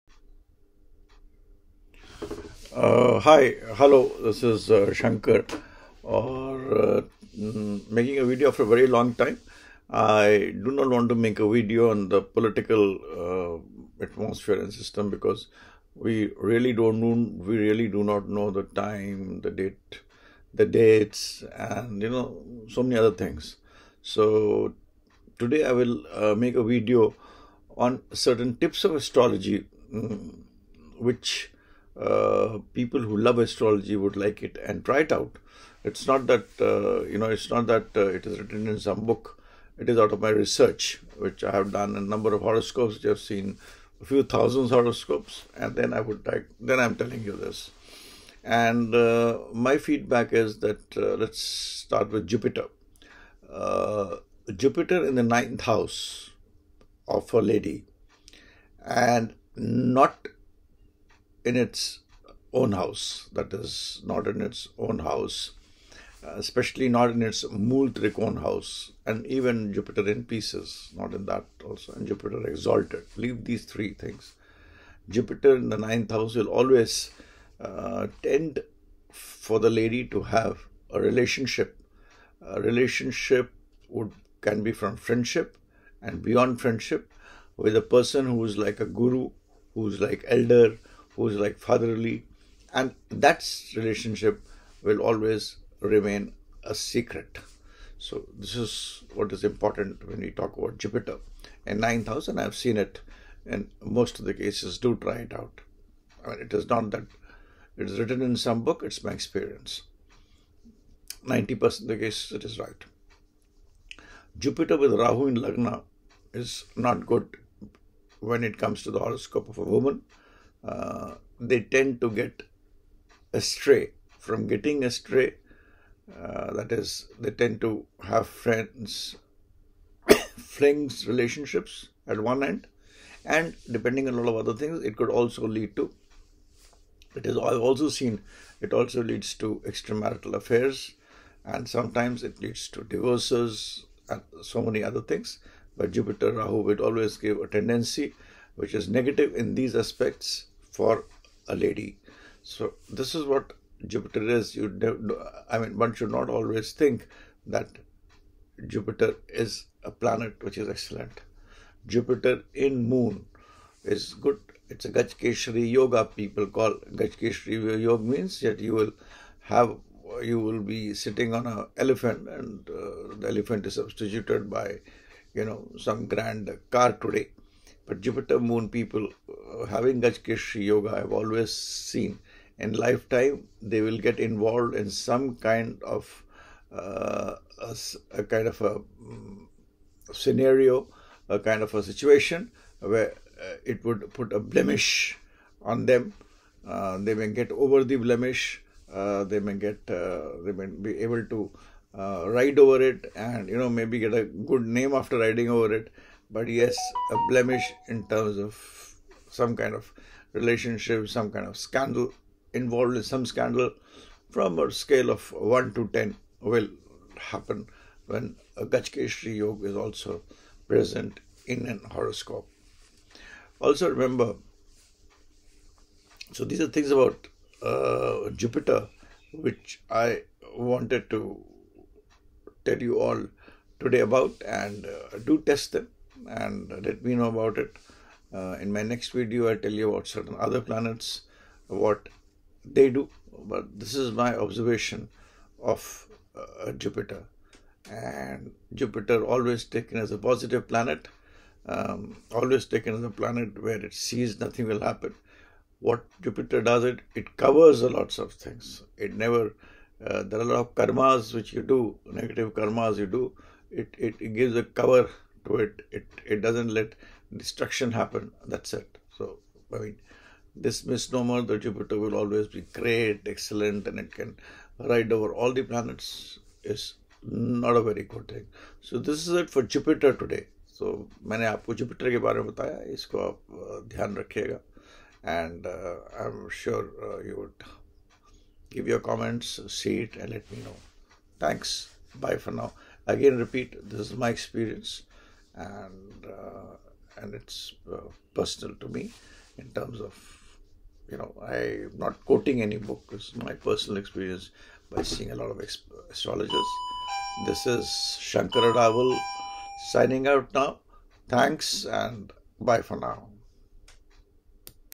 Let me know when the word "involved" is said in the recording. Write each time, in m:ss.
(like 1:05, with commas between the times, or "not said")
3:04, 3:32.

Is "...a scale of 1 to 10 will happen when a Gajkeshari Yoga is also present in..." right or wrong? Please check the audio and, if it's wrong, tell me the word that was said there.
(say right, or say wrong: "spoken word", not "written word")
right.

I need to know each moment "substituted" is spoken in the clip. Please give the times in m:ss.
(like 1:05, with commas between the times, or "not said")
2:53.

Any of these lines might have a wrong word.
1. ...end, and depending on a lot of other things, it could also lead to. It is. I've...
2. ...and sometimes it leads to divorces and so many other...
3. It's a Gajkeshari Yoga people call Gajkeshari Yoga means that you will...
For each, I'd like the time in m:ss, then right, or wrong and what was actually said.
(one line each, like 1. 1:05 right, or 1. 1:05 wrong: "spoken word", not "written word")
1. 2:12 right
2. 2:21 right
3. 2:44 right.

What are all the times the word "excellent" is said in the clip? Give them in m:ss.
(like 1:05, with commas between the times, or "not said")
2:40, 4:33.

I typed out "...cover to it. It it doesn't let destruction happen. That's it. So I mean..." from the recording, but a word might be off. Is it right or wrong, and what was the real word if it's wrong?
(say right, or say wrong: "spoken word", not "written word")
right.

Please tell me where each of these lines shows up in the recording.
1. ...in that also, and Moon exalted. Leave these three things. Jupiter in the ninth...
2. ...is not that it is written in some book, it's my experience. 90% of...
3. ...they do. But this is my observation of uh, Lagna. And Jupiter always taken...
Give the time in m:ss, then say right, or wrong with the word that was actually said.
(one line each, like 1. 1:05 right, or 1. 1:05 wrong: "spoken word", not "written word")
1. 1:11 wrong: "Jupiter", not "Moon"
2. 1:46 right
3. 4:02 wrong: "Jupiter", not "Lagna".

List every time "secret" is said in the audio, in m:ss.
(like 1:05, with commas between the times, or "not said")
1:36.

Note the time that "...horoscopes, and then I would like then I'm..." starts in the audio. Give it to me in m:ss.
0:44.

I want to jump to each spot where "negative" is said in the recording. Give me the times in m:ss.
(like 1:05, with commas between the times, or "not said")
2:28, 4:22.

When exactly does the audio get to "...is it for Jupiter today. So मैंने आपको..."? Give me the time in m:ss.
4:39.